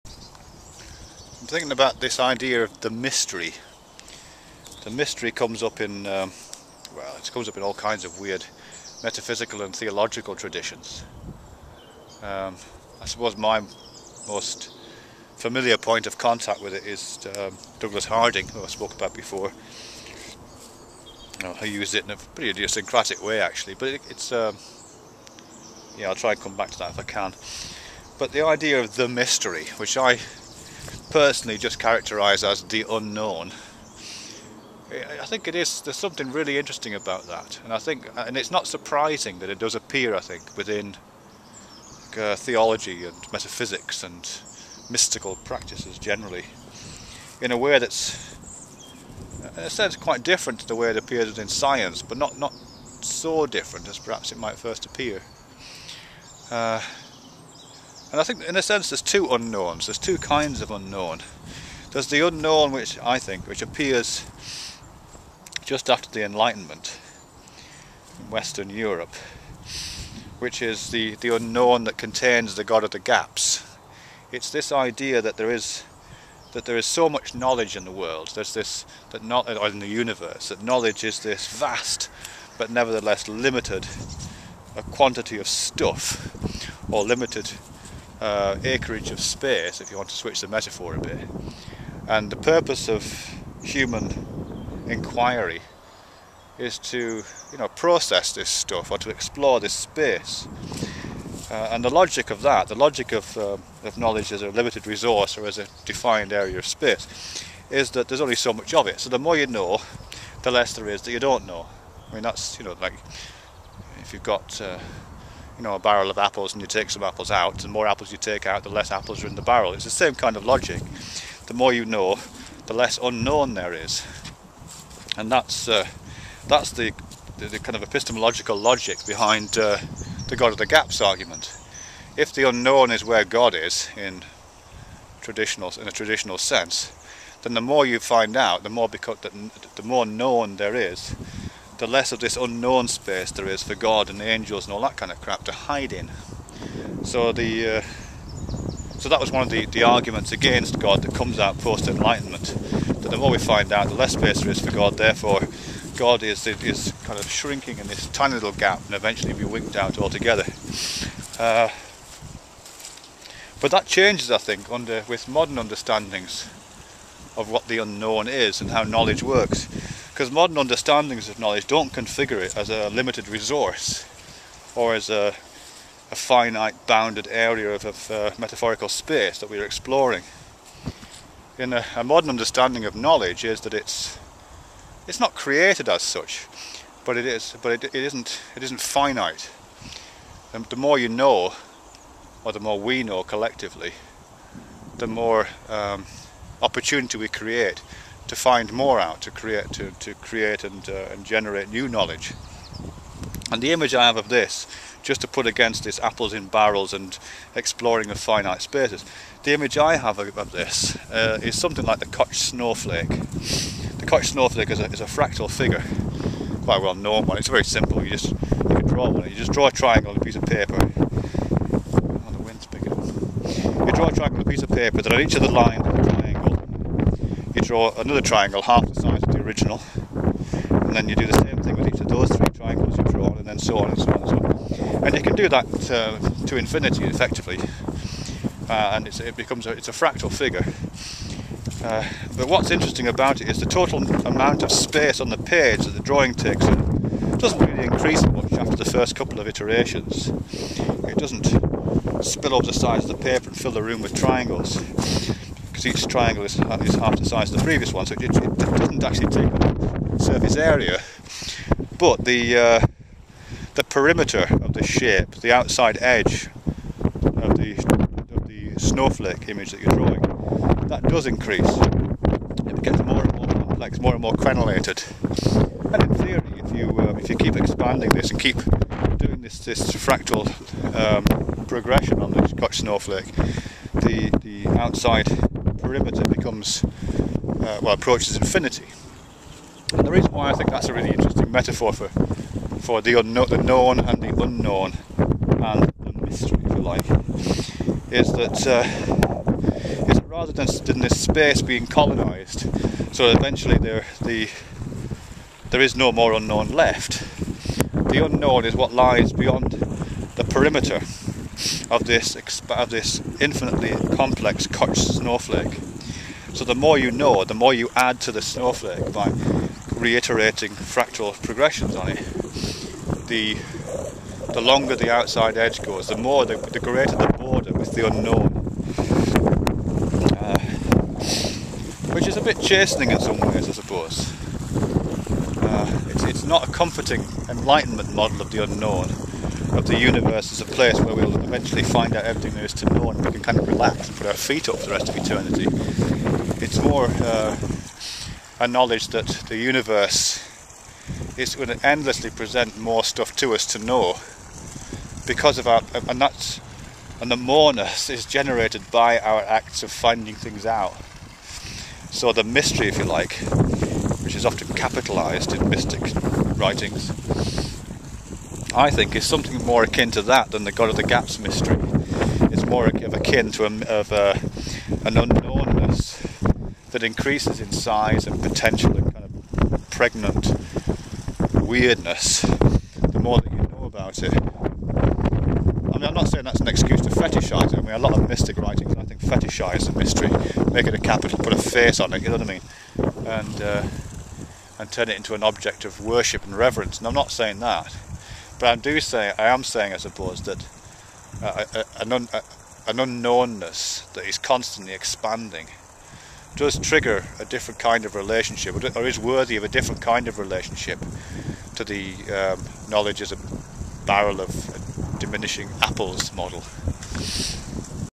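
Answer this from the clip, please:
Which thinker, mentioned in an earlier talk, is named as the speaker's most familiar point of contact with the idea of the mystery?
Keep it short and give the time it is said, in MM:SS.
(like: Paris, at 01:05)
Douglas Harding, at 00:17.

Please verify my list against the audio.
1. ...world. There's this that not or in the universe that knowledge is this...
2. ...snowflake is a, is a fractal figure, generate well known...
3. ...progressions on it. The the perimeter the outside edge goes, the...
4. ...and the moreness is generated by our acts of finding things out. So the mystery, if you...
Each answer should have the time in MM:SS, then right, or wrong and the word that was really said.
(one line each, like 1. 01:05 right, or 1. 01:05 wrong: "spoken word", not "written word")
1. 01:17 right
2. 03:34 wrong: "quite", not "generate"
3. 05:21 wrong: "longer", not "perimeter"
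4. 05:57 right.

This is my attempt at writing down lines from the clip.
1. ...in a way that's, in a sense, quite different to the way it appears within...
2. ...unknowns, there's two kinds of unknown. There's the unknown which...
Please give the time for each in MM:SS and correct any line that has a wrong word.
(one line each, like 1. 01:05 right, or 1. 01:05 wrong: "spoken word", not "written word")
1. 00:47 right
2. 00:59 right.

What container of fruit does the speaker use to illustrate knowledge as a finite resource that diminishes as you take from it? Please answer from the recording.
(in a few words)
a barrel of apples.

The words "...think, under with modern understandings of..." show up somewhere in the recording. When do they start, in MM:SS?
02:44.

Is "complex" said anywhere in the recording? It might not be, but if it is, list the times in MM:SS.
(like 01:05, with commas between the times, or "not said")
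04:33, 05:14.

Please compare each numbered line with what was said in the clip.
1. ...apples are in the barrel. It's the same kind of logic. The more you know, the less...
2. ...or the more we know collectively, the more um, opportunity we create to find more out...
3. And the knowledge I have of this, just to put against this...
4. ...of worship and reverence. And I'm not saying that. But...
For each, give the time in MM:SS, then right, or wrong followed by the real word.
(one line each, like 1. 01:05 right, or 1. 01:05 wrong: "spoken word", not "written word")
1. 01:58 right
2. 03:12 right
3. 03:23 wrong: "image", not "knowledge"
4. 06:35 right.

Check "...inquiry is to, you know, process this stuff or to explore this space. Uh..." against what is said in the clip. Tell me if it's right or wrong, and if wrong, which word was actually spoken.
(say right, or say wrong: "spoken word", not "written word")
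right.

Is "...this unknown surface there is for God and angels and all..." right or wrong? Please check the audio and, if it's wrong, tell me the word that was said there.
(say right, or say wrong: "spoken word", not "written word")
wrong: "space", not "surface".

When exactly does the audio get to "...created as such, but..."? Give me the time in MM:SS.
03:05.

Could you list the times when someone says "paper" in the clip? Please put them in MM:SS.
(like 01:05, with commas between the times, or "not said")
03:40, 03:44, 04:13.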